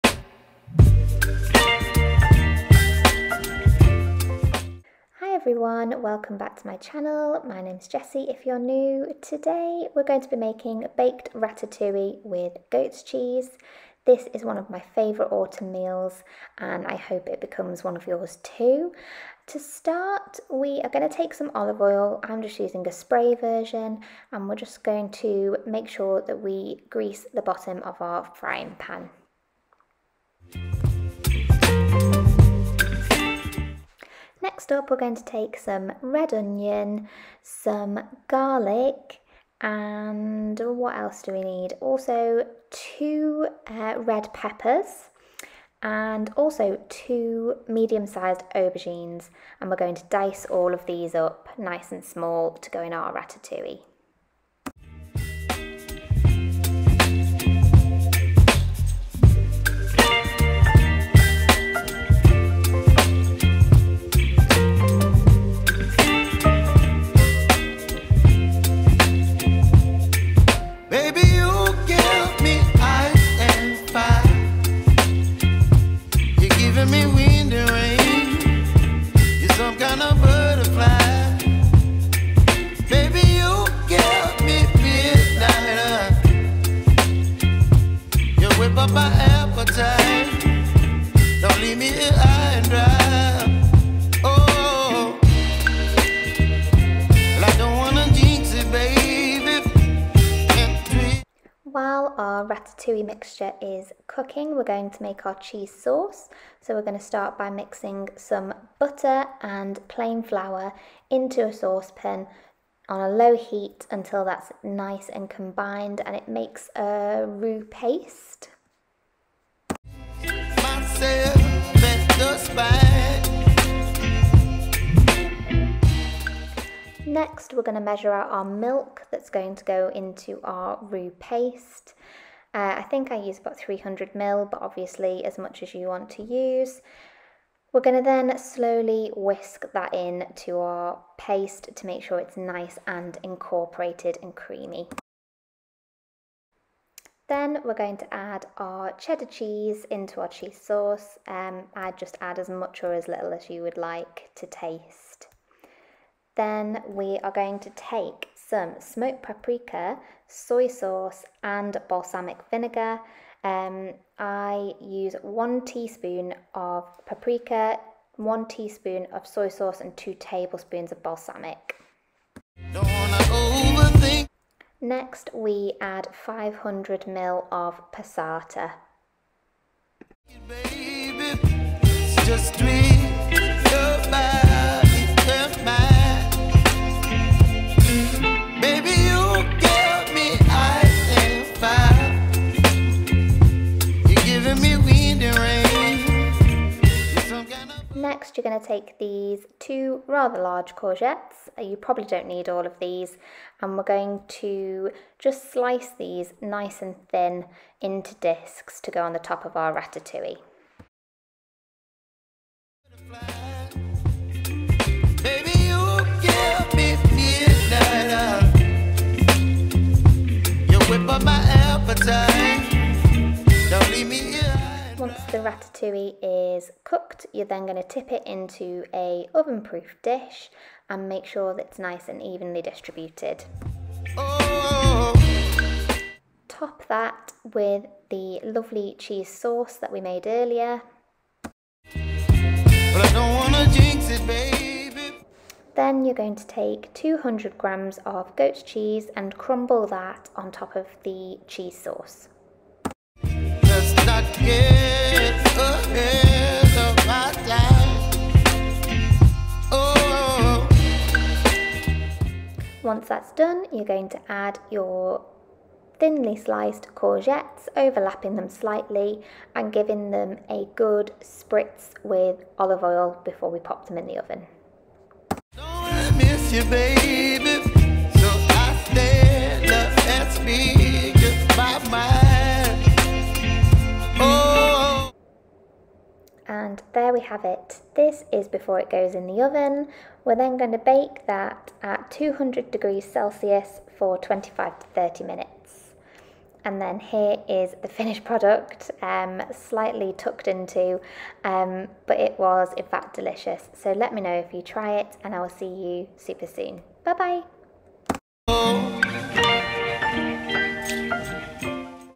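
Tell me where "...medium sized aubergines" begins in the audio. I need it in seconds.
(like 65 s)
47 s.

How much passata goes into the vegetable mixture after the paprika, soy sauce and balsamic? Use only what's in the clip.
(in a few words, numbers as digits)
500 ml.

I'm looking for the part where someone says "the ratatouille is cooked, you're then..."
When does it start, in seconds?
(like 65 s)
225 s.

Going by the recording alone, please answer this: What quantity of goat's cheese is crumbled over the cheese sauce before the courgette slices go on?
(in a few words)
200 grams.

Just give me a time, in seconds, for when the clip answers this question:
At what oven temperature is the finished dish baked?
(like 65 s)
292 s.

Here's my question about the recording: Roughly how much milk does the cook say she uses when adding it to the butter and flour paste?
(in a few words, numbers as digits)
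300ml.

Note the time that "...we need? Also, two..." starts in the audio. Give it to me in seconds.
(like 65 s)
41 s.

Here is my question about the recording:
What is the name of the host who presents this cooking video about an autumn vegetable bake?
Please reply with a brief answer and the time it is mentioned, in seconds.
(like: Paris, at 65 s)
Jessie, at 7 s.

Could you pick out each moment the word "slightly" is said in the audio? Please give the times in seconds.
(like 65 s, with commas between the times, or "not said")
268 s, 299 s.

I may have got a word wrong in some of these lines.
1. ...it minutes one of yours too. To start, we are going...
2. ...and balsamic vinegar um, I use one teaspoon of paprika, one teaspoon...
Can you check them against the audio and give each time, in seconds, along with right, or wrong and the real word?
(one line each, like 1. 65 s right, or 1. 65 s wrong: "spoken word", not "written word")
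1. 17 s wrong: "becomes", not "minutes"
2. 161 s right.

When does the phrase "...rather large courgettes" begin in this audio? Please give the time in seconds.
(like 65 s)
200 s.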